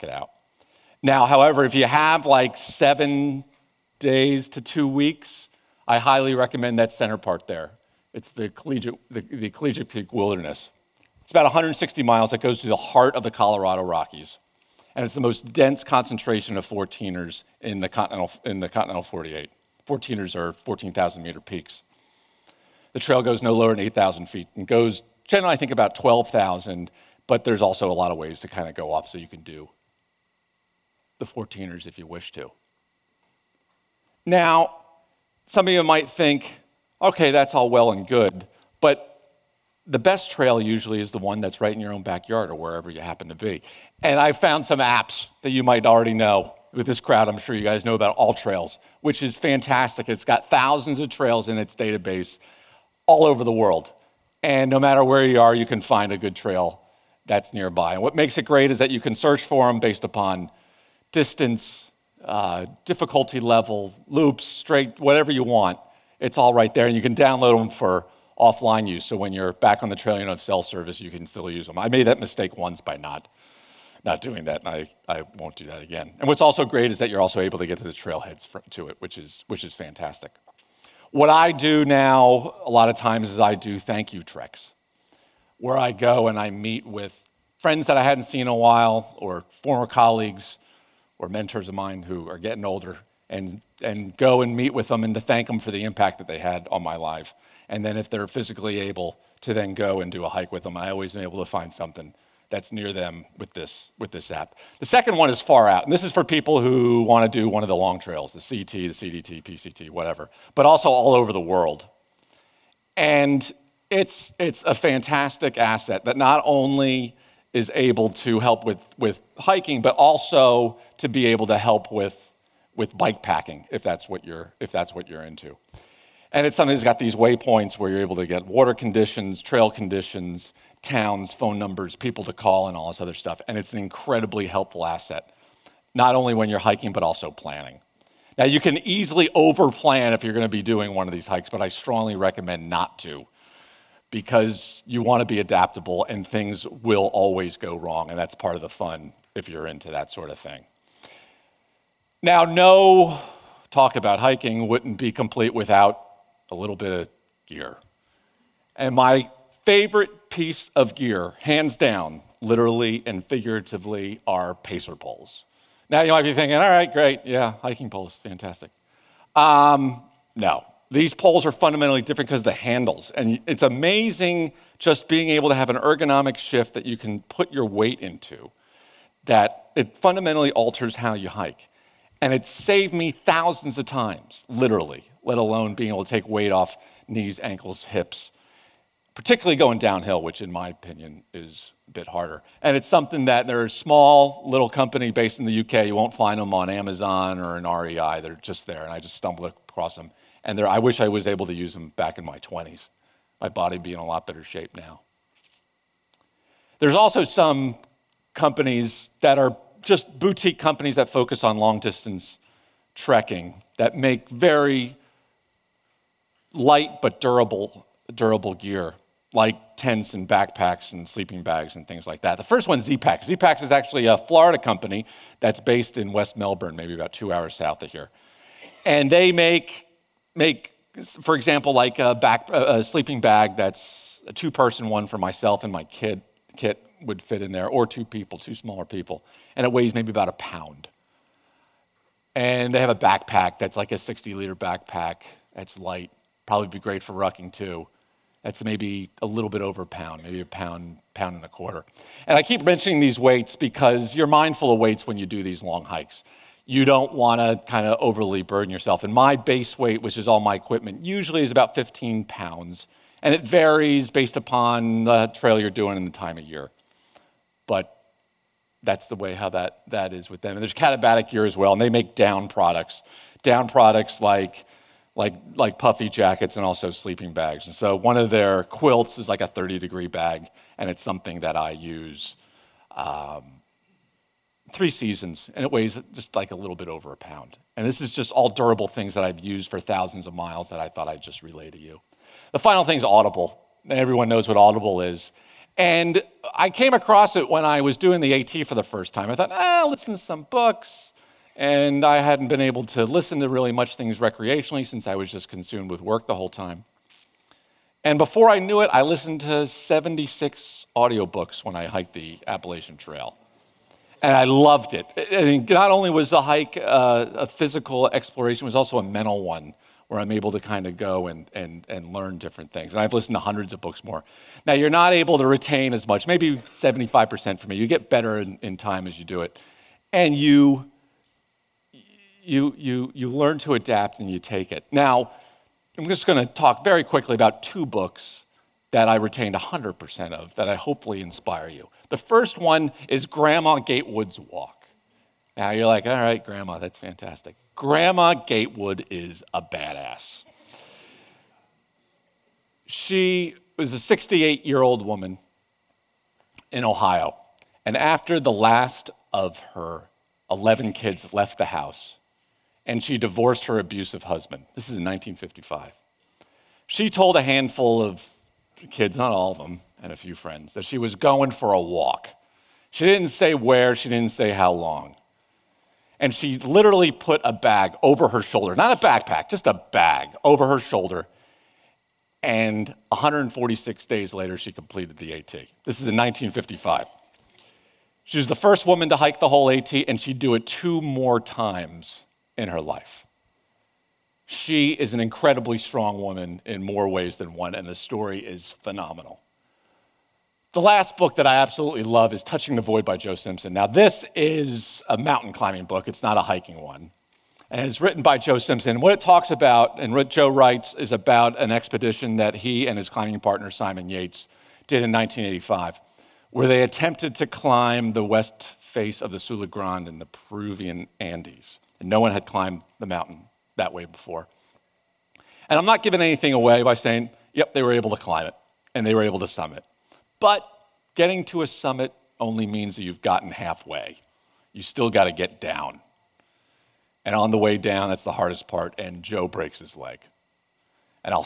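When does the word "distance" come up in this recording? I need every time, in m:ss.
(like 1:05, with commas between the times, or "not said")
1:01, 3:31.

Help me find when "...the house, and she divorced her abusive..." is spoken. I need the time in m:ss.
6:01.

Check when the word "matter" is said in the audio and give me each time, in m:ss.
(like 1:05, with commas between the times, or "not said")
0:54.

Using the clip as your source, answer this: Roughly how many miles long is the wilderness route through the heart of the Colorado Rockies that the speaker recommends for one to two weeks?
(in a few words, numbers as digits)
160 miles.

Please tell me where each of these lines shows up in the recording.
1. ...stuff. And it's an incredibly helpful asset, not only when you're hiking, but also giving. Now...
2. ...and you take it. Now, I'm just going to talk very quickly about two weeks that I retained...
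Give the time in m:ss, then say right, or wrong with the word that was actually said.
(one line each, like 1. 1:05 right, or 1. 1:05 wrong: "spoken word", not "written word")
1. 2:13 wrong: "planning", not "giving"
2. 5:34 wrong: "books", not "weeks".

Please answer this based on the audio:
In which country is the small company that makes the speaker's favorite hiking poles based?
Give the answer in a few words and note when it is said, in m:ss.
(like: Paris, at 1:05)
UK, at 3:15.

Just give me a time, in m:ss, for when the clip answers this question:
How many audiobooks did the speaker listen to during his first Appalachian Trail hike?
5:09.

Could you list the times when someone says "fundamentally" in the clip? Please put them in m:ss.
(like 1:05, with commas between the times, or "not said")
2:51, 2:59.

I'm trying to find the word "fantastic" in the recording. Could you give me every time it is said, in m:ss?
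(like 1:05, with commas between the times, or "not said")
0:49, 1:19, 1:54, 2:48, 5:46.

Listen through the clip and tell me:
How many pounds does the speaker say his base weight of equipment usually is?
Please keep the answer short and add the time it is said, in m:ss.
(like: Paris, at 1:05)
15 pounds, at 4:21.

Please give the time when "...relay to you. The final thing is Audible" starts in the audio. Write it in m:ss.
4:51.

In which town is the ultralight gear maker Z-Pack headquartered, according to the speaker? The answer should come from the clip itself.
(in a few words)
West Melbourne.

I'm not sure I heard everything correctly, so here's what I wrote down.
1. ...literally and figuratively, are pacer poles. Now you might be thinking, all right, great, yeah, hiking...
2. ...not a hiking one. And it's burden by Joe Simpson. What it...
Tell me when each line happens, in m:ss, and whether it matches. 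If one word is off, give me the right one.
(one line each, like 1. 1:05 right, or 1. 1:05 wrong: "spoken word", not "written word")
1. 2:42 right
2. 6:46 wrong: "written", not "burden".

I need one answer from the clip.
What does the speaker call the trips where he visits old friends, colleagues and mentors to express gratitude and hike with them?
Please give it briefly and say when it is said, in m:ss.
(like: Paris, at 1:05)
thank you treks, at 1:23.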